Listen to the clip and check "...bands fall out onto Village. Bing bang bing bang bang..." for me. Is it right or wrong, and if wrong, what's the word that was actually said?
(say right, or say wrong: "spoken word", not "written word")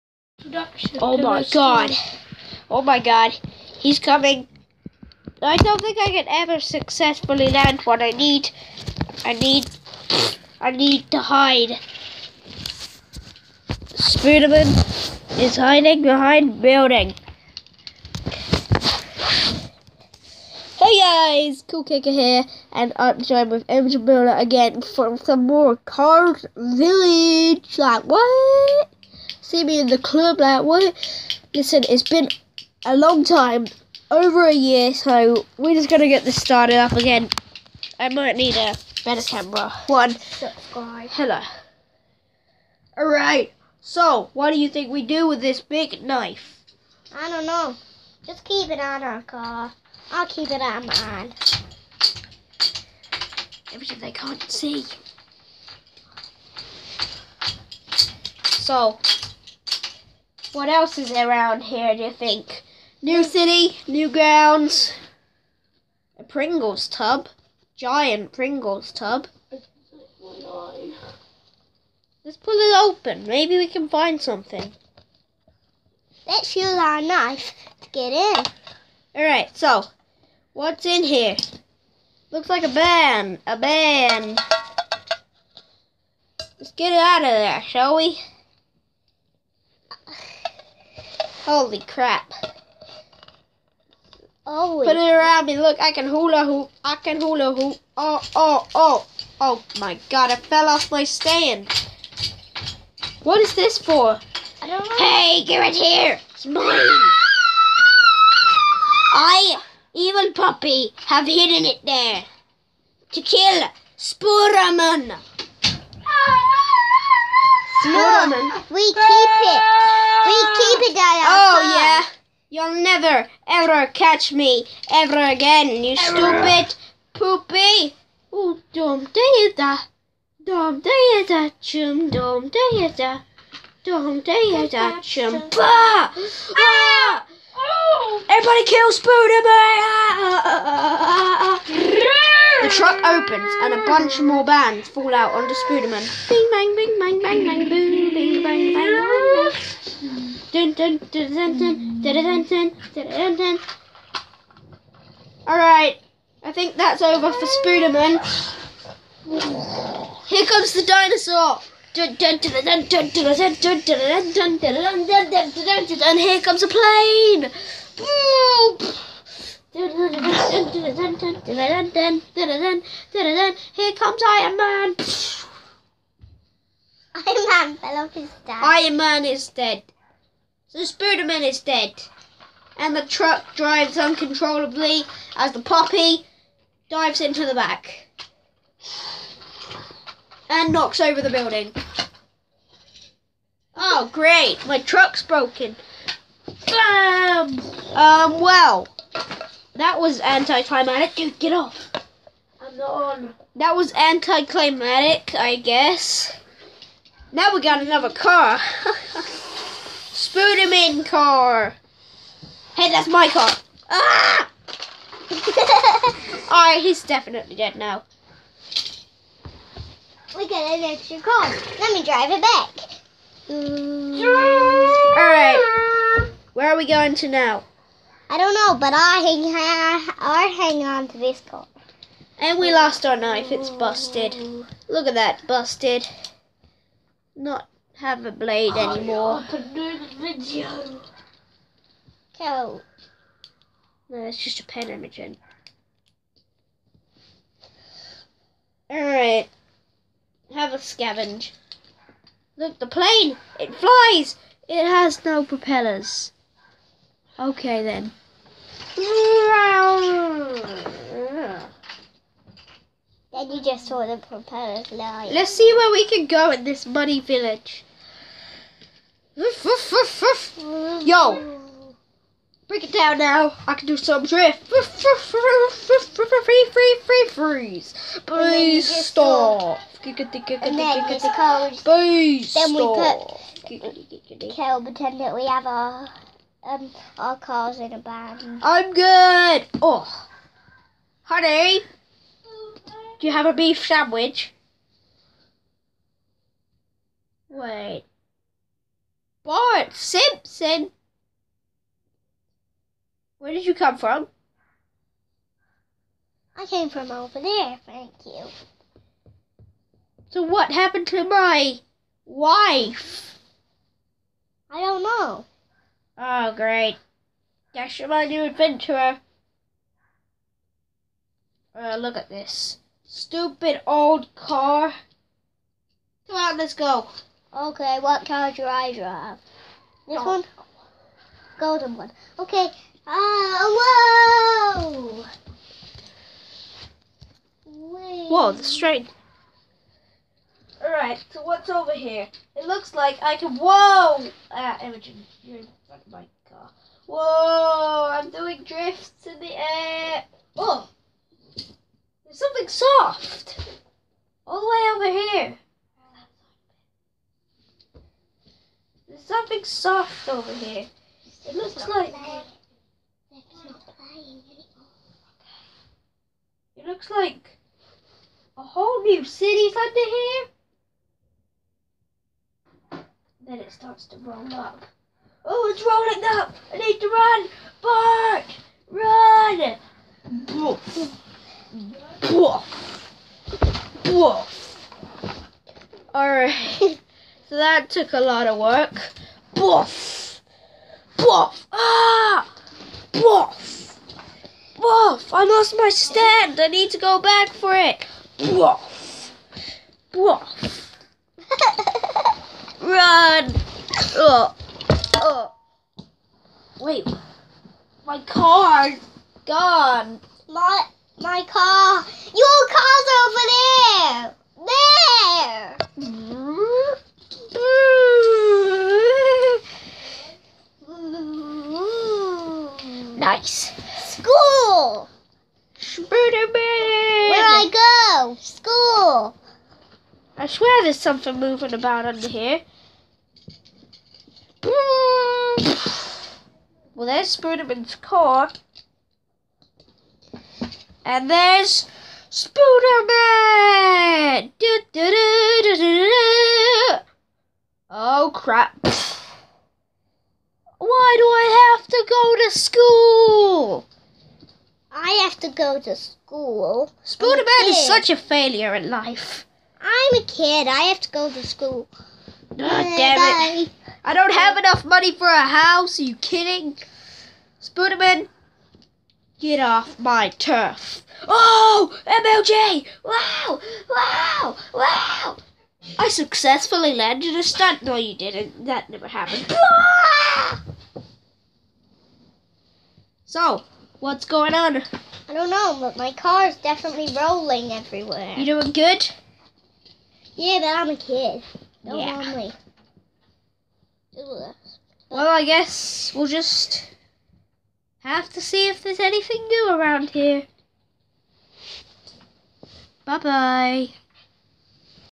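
wrong: "Spooderman", not "Village".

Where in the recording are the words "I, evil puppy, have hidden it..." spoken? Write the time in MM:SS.
01:49.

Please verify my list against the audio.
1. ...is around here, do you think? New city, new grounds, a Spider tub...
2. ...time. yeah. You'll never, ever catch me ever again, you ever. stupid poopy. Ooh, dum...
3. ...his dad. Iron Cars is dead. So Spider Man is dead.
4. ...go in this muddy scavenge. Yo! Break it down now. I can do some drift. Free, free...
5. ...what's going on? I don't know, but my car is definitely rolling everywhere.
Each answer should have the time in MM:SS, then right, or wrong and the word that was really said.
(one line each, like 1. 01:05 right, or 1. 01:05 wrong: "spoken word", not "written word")
1. 01:00 wrong: "Pringles", not "Spider"
2. 02:01 right
3. 02:58 wrong: "Man", not "Cars"
4. 04:26 wrong: "village", not "scavenge"
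5. 08:03 right.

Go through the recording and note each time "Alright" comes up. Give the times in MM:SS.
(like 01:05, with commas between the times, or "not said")
00:42, 01:19, 02:35, 03:36, 03:45, 04:08, 05:40, 06:26.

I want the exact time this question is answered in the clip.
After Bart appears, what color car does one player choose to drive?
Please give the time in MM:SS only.
05:31.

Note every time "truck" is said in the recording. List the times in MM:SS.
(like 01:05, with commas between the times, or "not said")
02:22, 03:03, 03:14.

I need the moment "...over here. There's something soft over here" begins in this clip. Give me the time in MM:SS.
05:55.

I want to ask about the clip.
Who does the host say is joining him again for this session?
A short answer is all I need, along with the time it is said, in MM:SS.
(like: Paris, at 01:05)
Angel Builder, at 00:23.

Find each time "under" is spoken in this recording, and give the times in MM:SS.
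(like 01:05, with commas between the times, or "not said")
06:09, 07:12.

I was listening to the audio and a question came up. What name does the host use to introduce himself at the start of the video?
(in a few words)
Cool Kicker.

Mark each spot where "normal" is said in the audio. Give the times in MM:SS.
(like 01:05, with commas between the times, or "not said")
not said.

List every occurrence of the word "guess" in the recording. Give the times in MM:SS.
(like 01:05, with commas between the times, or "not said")
03:25, 08:15.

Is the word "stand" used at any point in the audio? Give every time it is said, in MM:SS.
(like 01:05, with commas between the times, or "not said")
01:41, 06:35.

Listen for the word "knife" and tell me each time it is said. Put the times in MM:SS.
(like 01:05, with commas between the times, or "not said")
00:46, 01:17, 03:53.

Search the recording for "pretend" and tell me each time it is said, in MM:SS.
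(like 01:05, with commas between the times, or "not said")
04:44.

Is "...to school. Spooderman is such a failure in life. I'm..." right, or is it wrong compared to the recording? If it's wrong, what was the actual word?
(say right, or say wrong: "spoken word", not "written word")
right.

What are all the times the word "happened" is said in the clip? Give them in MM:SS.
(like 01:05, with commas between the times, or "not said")
05:10, 07:59.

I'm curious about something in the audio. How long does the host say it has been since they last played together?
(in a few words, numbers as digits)
over a year.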